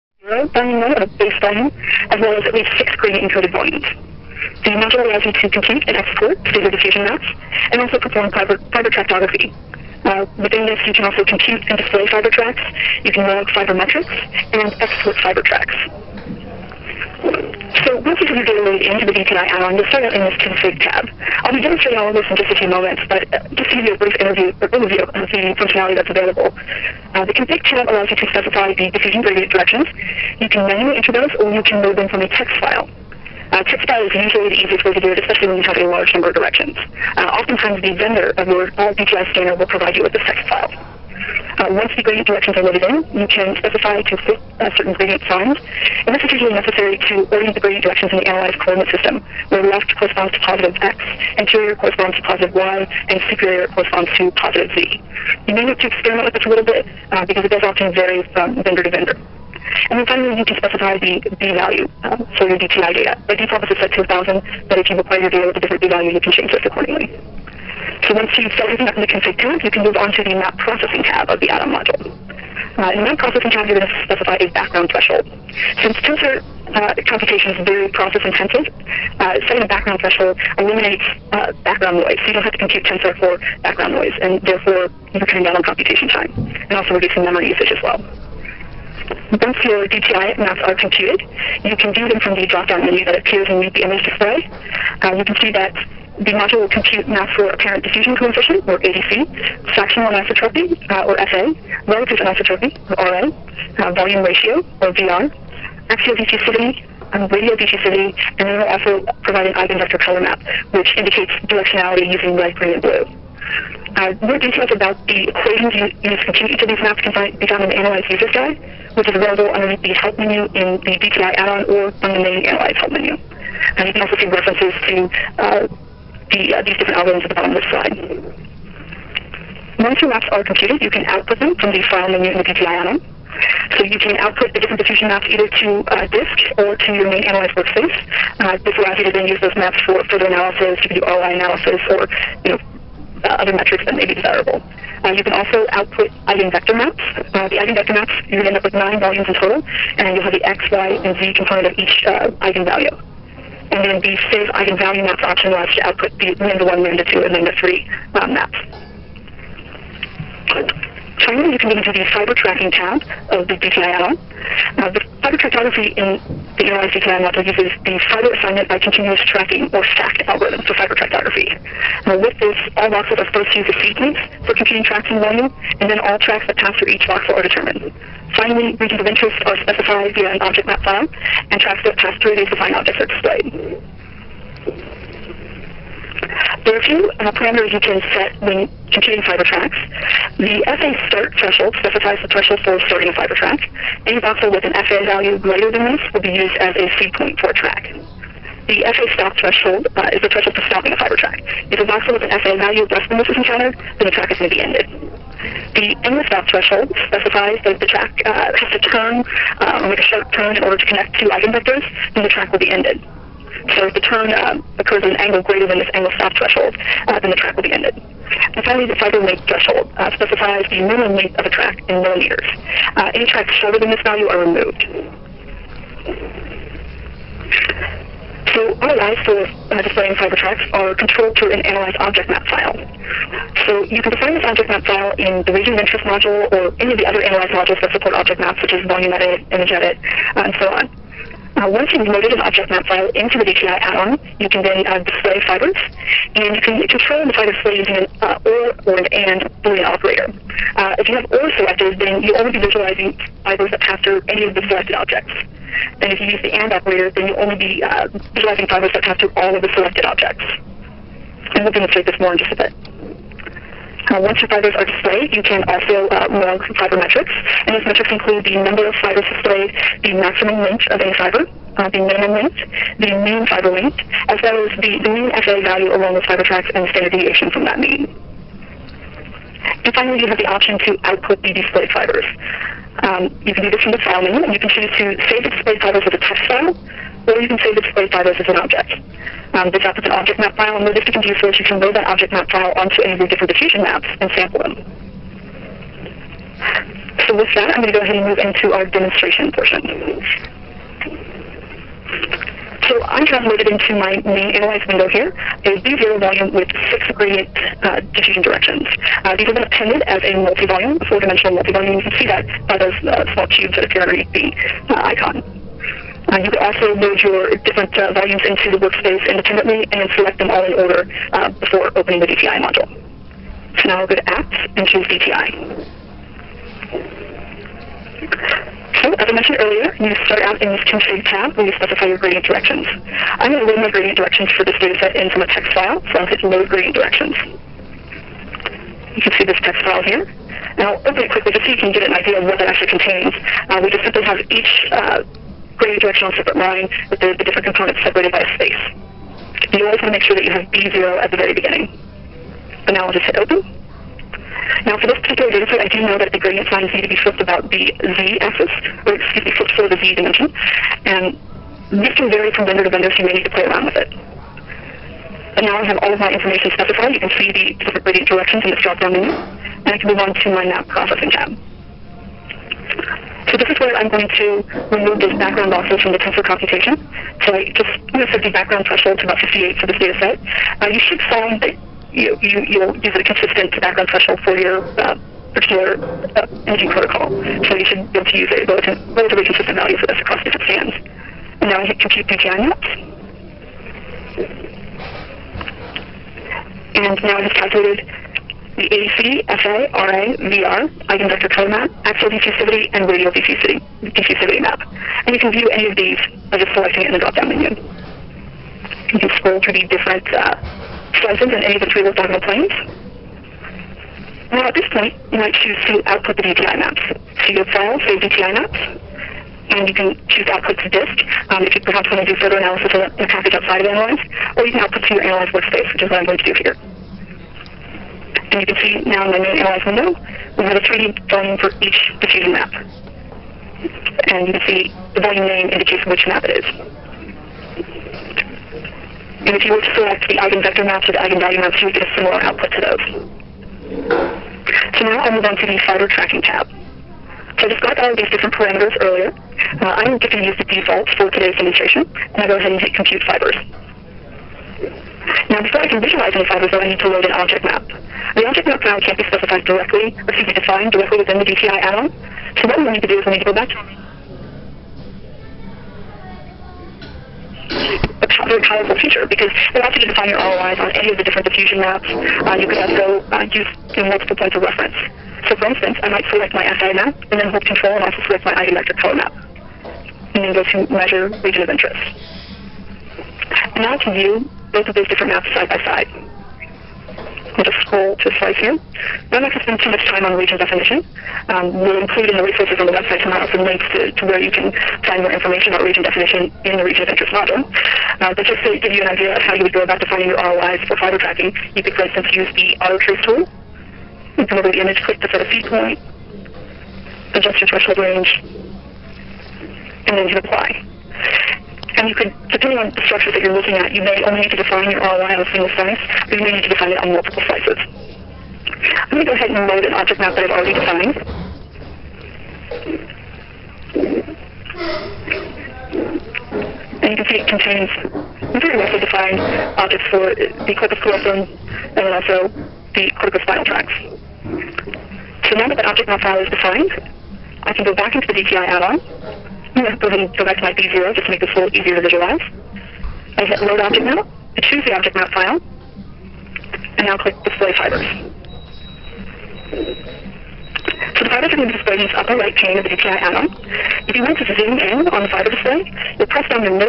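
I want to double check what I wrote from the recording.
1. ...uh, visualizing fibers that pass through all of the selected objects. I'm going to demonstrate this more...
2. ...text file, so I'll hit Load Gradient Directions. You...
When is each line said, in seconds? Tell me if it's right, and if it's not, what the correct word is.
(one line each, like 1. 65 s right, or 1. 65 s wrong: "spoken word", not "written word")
1. 257 s right
2. 335 s right.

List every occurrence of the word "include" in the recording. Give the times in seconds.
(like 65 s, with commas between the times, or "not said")
268 s, 491 s.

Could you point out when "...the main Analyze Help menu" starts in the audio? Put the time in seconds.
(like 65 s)
122 s.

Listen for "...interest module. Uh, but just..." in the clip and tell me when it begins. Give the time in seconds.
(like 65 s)
497 s.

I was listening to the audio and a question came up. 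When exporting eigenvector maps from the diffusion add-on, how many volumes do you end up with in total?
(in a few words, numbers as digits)
nine.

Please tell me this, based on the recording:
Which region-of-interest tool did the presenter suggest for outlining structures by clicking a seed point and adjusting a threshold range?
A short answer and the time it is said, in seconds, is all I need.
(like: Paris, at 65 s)
auto trace tool, at 502 s.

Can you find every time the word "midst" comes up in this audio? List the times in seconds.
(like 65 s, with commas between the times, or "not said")
not said.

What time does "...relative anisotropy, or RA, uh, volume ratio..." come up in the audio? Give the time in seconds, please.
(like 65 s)
101 s.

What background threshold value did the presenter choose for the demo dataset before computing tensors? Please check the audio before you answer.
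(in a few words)
58.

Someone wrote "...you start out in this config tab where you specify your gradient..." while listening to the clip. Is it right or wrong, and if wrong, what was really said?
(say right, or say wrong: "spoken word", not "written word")
right.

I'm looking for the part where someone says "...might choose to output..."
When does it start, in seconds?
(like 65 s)
415 s.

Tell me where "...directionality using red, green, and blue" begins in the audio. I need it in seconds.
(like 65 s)
111 s.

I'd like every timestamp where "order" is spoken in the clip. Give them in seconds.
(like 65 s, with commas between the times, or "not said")
210 s, 320 s.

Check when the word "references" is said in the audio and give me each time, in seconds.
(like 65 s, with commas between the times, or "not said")
124 s, 474 s.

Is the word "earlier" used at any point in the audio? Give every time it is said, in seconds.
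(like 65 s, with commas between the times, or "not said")
329 s, 449 s.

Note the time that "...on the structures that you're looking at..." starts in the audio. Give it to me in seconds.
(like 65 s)
512 s.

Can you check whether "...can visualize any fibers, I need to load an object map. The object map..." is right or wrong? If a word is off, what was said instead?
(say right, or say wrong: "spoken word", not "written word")
right.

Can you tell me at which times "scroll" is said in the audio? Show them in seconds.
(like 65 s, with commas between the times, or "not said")
409 s, 487 s.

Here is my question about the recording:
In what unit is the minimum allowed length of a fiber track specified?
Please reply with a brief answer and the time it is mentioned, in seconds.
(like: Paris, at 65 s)
millimeters, at 222 s.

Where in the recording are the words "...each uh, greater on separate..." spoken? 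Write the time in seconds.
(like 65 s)
344 s.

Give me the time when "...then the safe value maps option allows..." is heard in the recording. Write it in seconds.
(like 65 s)
153 s.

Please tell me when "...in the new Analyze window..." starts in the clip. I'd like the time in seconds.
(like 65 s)
429 s.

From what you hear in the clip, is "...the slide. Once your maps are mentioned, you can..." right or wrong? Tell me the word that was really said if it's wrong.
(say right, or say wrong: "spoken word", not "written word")
wrong: "computed", not "mentioned".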